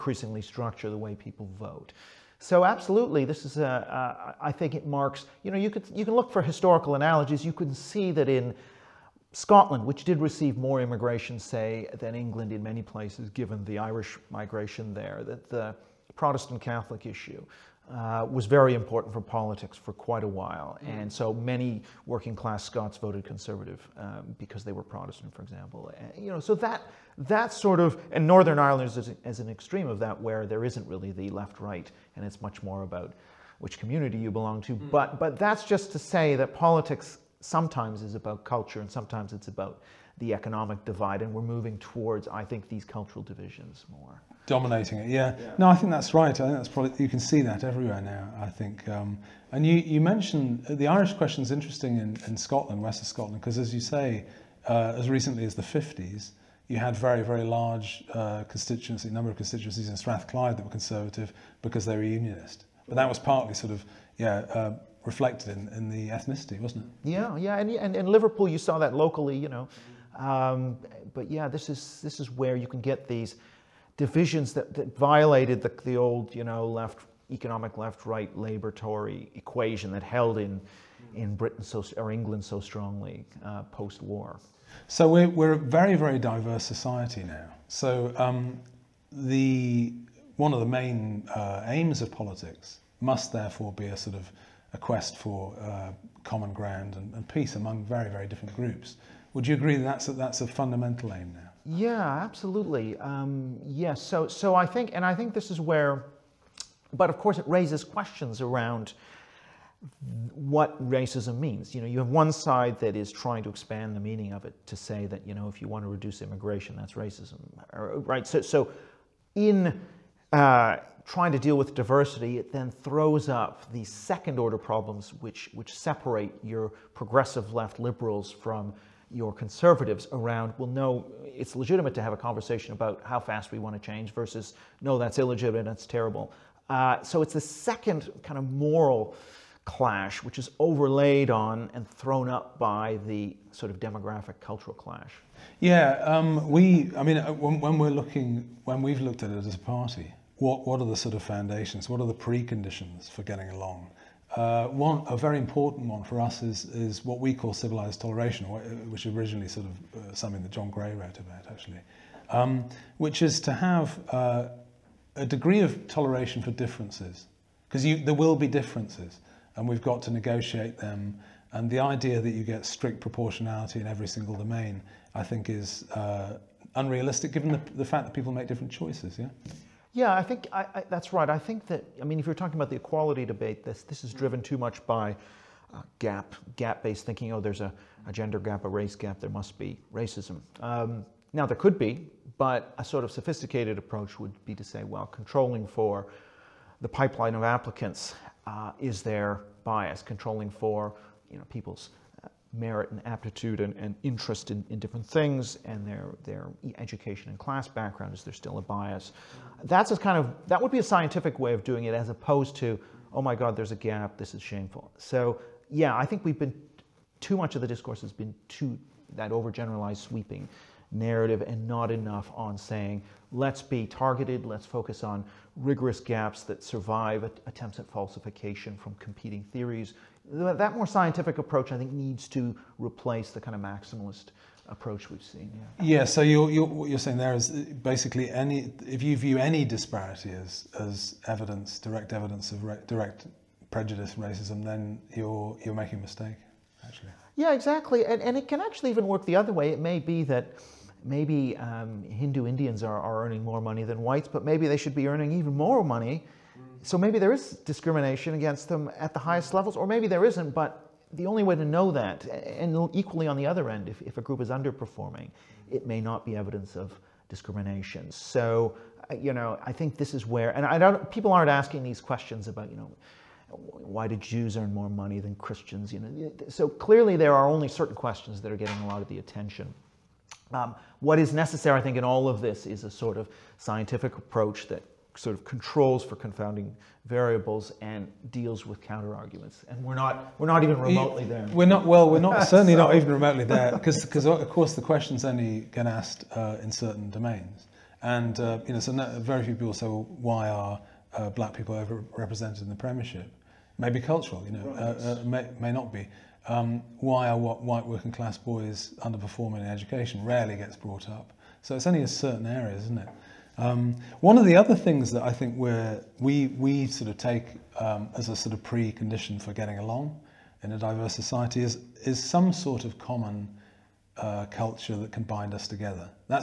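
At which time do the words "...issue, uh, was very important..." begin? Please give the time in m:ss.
0:17.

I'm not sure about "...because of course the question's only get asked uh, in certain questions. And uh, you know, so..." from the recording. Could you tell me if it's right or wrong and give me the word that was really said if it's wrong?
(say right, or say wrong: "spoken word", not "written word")
wrong: "domains", not "questions".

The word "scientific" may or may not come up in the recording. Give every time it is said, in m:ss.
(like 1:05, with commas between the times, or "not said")
3:30, 3:50, 4:43.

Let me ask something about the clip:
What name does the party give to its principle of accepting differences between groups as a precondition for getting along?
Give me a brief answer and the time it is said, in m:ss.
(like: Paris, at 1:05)
civilized toleration, at 2:37.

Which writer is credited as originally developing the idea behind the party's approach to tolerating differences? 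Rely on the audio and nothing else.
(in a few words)
John Gray.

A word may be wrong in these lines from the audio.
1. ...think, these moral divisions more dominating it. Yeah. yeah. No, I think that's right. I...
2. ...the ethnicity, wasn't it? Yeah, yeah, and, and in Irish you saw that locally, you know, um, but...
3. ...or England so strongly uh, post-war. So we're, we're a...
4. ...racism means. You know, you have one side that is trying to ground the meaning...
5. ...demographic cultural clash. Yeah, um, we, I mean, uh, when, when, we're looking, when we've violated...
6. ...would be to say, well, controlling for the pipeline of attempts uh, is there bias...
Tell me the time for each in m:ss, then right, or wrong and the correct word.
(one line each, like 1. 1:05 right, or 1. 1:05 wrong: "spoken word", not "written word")
1. 0:42 wrong: "cultural", not "moral"
2. 1:05 wrong: "Liverpool", not "Irish"
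3. 1:21 right
4. 1:50 wrong: "expand", not "ground"
5. 2:23 wrong: "looked", not "violated"
6. 3:14 wrong: "applicants", not "attempts".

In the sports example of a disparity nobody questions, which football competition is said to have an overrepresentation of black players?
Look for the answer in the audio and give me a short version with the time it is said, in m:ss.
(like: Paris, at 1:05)
the Premiership, at 5:02.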